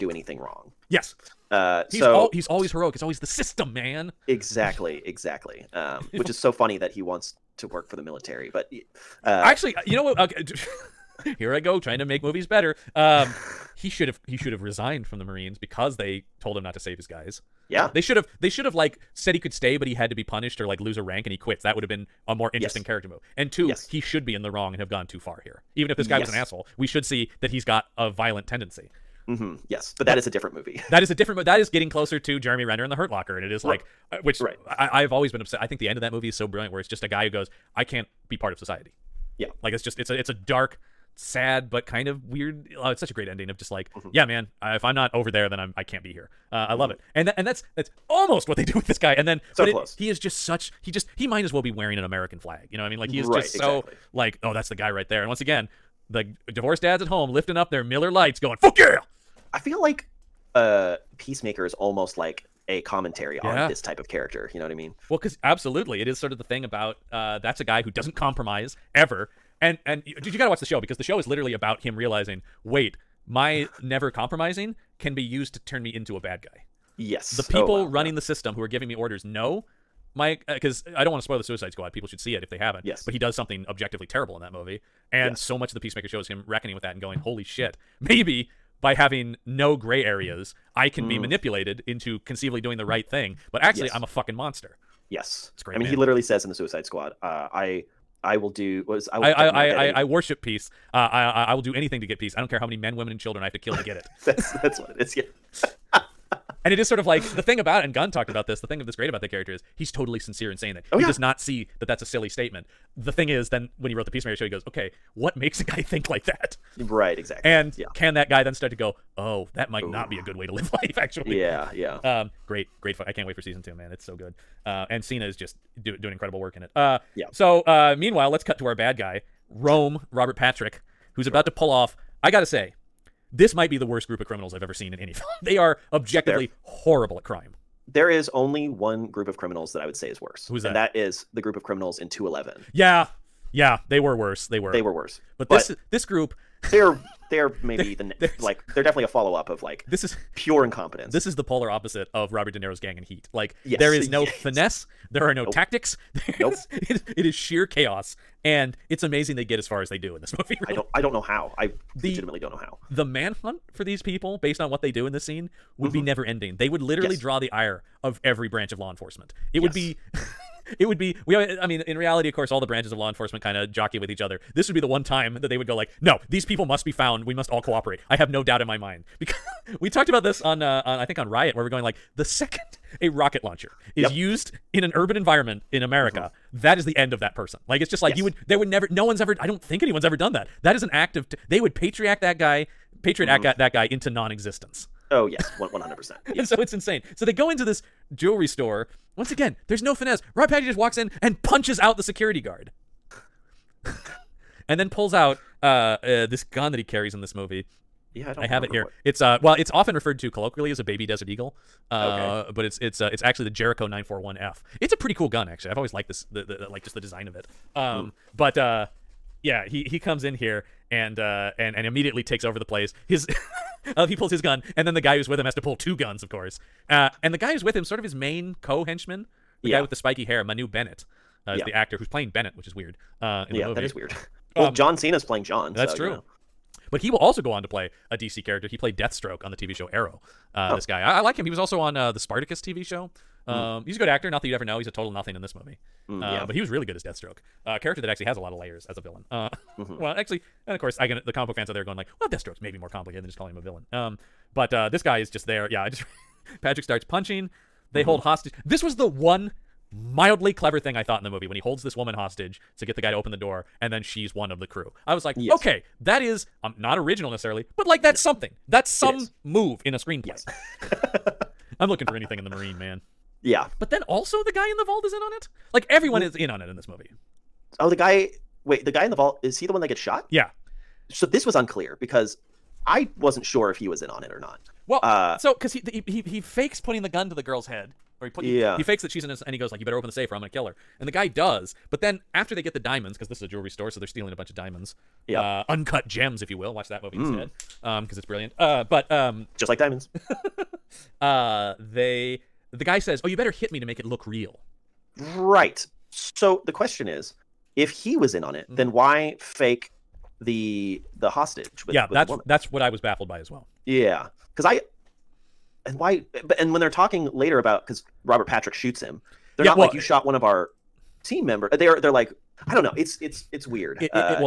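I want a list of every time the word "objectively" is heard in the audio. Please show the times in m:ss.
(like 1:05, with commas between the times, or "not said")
1:23, 2:15.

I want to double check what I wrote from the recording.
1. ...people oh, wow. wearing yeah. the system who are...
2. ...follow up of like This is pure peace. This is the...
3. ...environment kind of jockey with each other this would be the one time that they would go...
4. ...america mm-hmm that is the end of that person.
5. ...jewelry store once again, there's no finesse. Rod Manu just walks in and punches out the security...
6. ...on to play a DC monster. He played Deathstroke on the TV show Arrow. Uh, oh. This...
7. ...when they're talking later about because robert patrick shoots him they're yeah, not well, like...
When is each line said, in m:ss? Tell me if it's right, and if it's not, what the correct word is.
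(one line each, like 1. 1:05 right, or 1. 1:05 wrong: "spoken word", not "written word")
1. 1:17 wrong: "running", not "wearing"
2. 2:29 wrong: "incompetence", not "peace"
3. 2:53 wrong: "enforcement", not "environment"
4. 3:05 right
5. 3:18 wrong: "Patty", not "Manu"
6. 3:57 wrong: "character", not "monster"
7. 5:16 right.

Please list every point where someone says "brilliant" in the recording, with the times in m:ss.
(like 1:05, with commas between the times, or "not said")
0:36, 4:58.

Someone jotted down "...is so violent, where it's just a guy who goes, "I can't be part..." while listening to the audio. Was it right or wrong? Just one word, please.
wrong.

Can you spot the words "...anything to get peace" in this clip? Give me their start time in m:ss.
1:41.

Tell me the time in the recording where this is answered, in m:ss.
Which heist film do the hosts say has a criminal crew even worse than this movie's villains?
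2:22.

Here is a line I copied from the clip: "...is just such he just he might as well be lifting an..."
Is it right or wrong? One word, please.
wrong.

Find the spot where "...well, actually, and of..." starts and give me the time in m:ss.
4:10.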